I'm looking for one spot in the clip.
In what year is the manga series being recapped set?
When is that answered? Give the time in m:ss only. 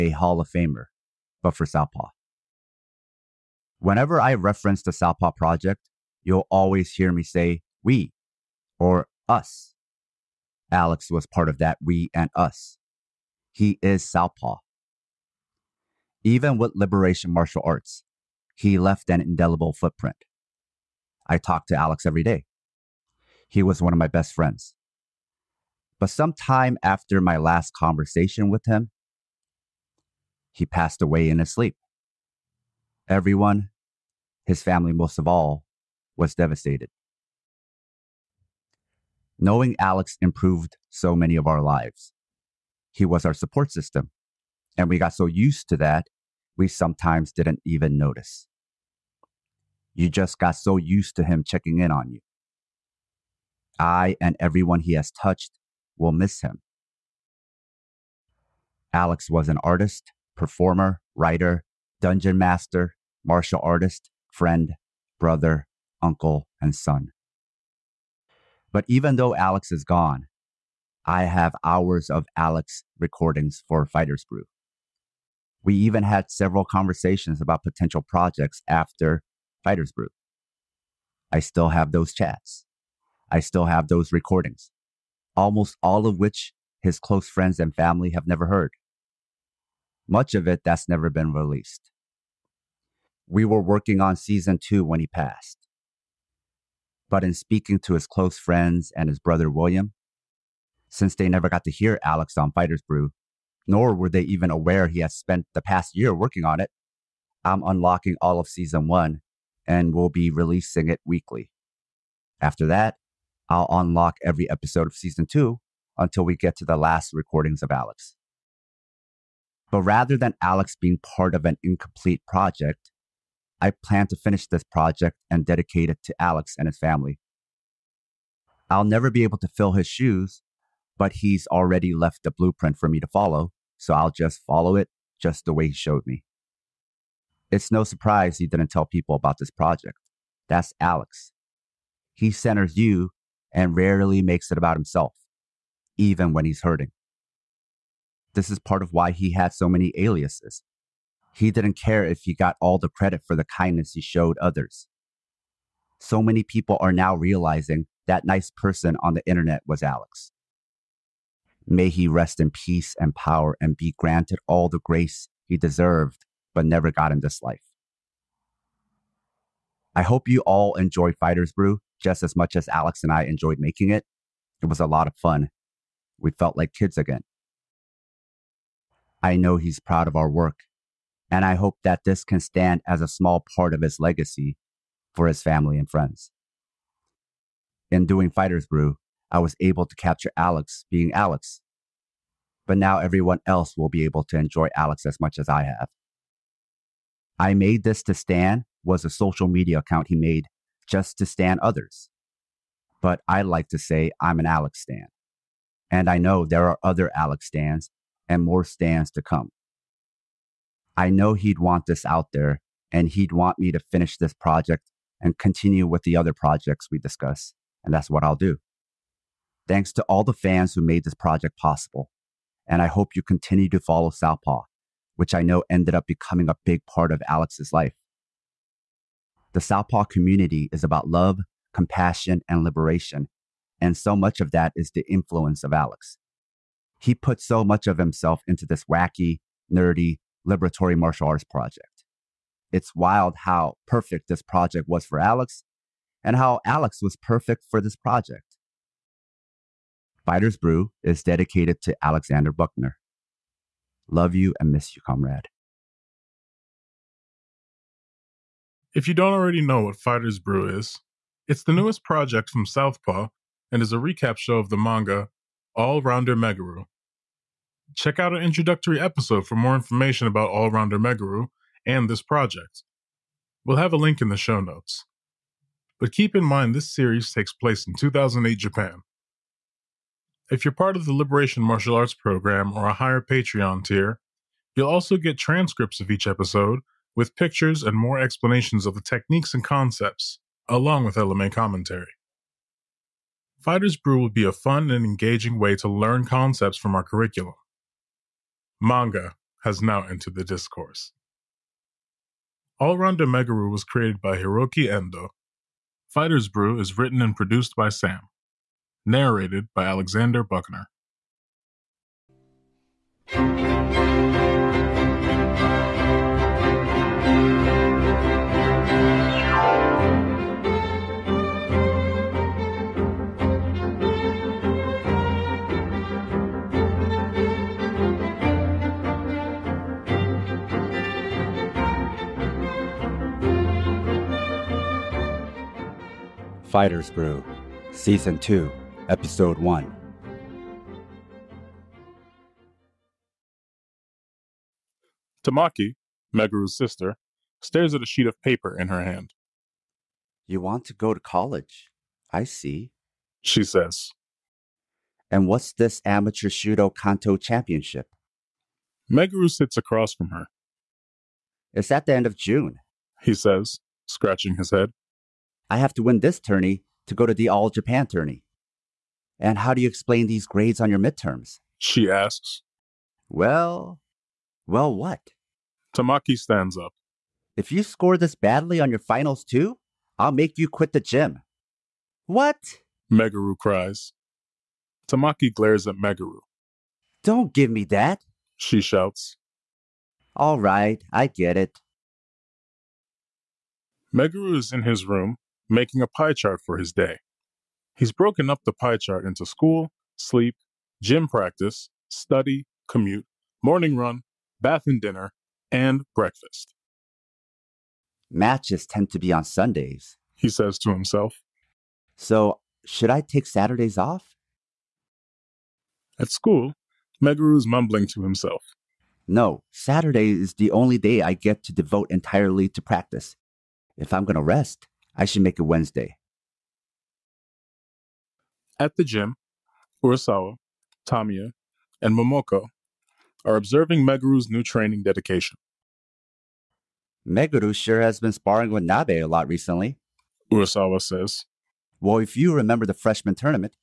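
4:37.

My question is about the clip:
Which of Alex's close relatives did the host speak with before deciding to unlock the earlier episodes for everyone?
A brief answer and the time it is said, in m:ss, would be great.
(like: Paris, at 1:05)
William, at 1:39.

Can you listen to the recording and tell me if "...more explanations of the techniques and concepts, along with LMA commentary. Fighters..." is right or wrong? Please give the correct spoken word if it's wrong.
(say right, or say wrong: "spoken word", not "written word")
right.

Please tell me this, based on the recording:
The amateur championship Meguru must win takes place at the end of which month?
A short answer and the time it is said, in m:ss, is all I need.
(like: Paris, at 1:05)
June, at 6:02.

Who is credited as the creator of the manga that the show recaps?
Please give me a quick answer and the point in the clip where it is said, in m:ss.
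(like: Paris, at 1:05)
Hiroki Endo, at 5:04.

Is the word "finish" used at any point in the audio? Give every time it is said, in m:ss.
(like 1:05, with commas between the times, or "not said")
2:04, 3:33.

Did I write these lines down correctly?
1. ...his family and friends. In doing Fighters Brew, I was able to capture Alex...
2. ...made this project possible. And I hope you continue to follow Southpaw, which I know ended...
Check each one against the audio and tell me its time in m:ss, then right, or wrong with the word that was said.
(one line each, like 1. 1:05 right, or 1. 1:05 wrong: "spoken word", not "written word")
1. 3:05 right
2. 3:40 right.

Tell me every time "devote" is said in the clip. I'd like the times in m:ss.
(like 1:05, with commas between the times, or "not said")
7:01.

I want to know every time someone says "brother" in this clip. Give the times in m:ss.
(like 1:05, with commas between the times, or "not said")
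1:05, 1:39.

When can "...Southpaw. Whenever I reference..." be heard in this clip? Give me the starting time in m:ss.
0:01.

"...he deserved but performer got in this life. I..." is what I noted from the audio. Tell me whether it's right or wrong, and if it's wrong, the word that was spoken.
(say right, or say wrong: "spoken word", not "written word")
wrong: "never", not "performer".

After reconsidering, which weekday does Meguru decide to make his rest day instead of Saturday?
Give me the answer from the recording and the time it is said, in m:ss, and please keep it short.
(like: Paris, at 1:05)
Wednesday, at 7:05.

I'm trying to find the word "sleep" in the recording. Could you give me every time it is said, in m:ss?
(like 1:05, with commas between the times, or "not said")
0:31, 6:40.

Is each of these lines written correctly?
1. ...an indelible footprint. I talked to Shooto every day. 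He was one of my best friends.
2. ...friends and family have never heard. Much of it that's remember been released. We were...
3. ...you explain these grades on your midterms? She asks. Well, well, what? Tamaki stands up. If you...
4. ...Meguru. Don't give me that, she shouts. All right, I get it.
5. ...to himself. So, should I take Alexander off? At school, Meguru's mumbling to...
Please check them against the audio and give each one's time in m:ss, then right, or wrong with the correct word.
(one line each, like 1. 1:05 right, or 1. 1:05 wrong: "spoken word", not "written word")
1. 0:19 wrong: "Alex", not "Shooto"
2. 1:27 wrong: "never", not "remember"
3. 6:09 right
4. 6:25 right
5. 6:50 wrong: "Saturdays", not "Alexander".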